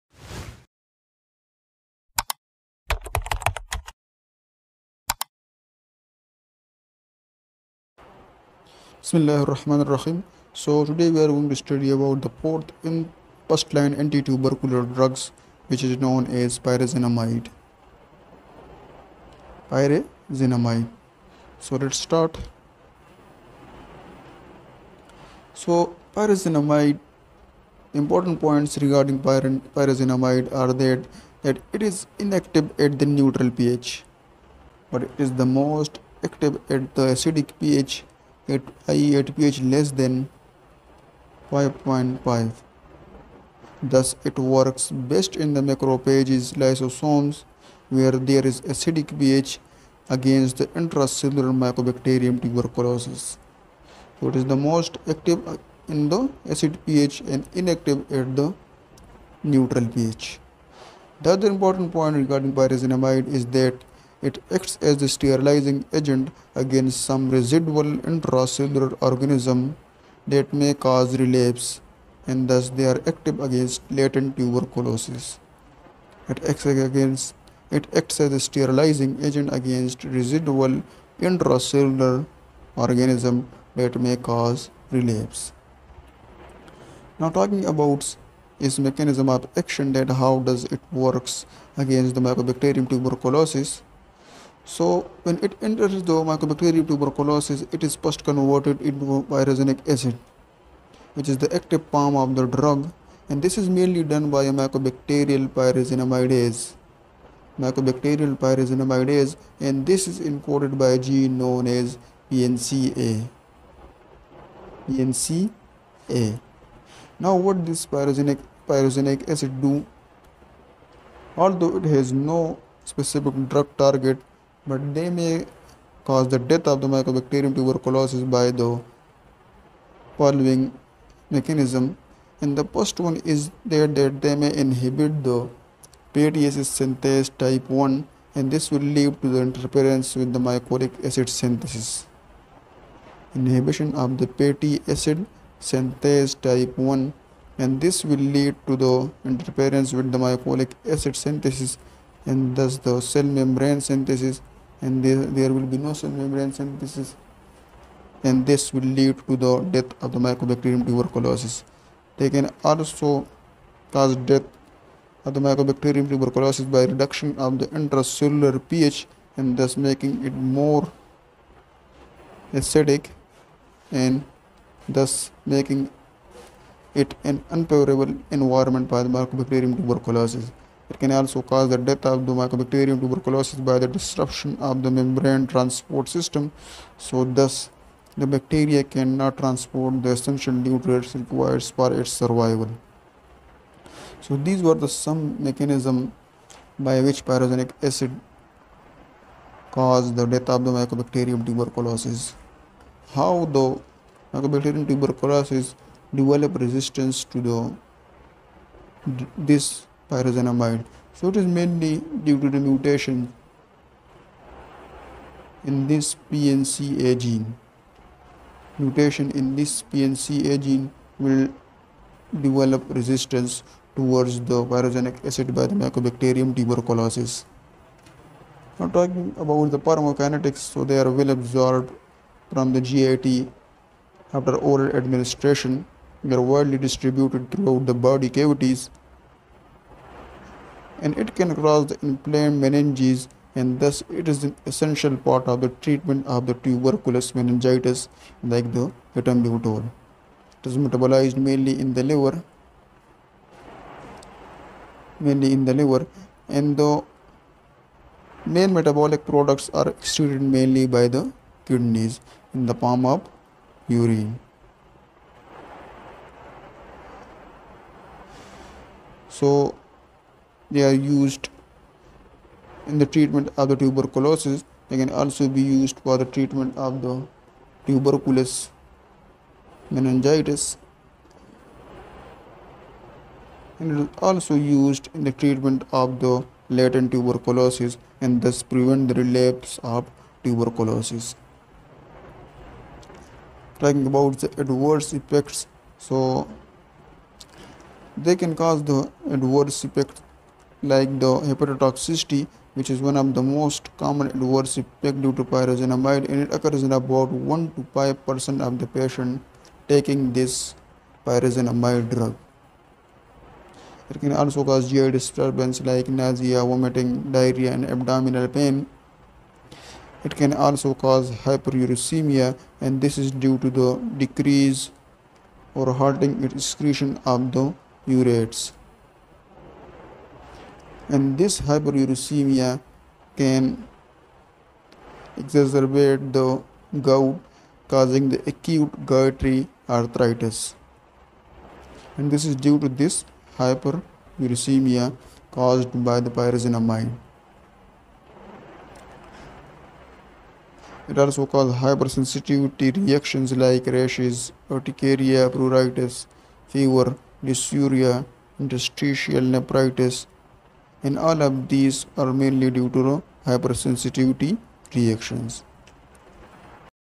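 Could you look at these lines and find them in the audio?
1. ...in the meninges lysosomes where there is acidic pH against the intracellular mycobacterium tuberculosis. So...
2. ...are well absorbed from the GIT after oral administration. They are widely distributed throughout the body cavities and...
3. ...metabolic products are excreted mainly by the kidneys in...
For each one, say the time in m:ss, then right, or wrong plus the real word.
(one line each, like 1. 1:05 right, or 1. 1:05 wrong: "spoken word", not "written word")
1. 0:45 wrong: "macrophages", not "meninges"
2. 3:50 right
3. 4:18 right.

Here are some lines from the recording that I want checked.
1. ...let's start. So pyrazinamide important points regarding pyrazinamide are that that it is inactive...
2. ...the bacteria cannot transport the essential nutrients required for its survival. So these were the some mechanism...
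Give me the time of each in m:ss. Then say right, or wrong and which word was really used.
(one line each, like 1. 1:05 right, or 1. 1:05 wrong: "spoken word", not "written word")
1. 0:21 right
2. 3:08 right.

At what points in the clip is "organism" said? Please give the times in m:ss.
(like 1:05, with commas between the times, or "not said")
1:09, 1:22.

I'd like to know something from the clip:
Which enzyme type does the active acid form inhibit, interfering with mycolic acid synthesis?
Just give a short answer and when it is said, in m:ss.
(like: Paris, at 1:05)
fatty acid synthase type 1, at 2:24.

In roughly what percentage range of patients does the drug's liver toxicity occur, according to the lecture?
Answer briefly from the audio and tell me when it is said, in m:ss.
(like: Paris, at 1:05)
1 to 5 percent, at 5:07.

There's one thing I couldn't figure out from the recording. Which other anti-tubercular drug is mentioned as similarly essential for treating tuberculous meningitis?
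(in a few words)
ethambutol.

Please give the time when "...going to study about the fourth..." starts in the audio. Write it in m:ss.
0:11.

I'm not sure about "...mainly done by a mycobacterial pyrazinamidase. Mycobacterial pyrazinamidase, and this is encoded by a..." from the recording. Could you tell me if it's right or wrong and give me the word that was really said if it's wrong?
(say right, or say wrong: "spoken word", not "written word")
right.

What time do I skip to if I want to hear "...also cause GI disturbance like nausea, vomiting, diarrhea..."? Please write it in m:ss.
5:14.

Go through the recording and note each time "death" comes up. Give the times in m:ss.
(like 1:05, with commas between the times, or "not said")
2:06, 2:39, 2:44, 3:01, 3:20.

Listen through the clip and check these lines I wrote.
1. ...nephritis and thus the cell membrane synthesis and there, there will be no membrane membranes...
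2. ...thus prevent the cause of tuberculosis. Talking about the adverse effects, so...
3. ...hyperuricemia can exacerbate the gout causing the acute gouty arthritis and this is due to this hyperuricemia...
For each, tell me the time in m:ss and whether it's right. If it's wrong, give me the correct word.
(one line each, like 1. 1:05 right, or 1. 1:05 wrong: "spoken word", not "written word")
1. 2:31 wrong: "synthesis", not "nephritis"
2. 4:48 wrong: "relapse", not "cause"
3. 5:31 right.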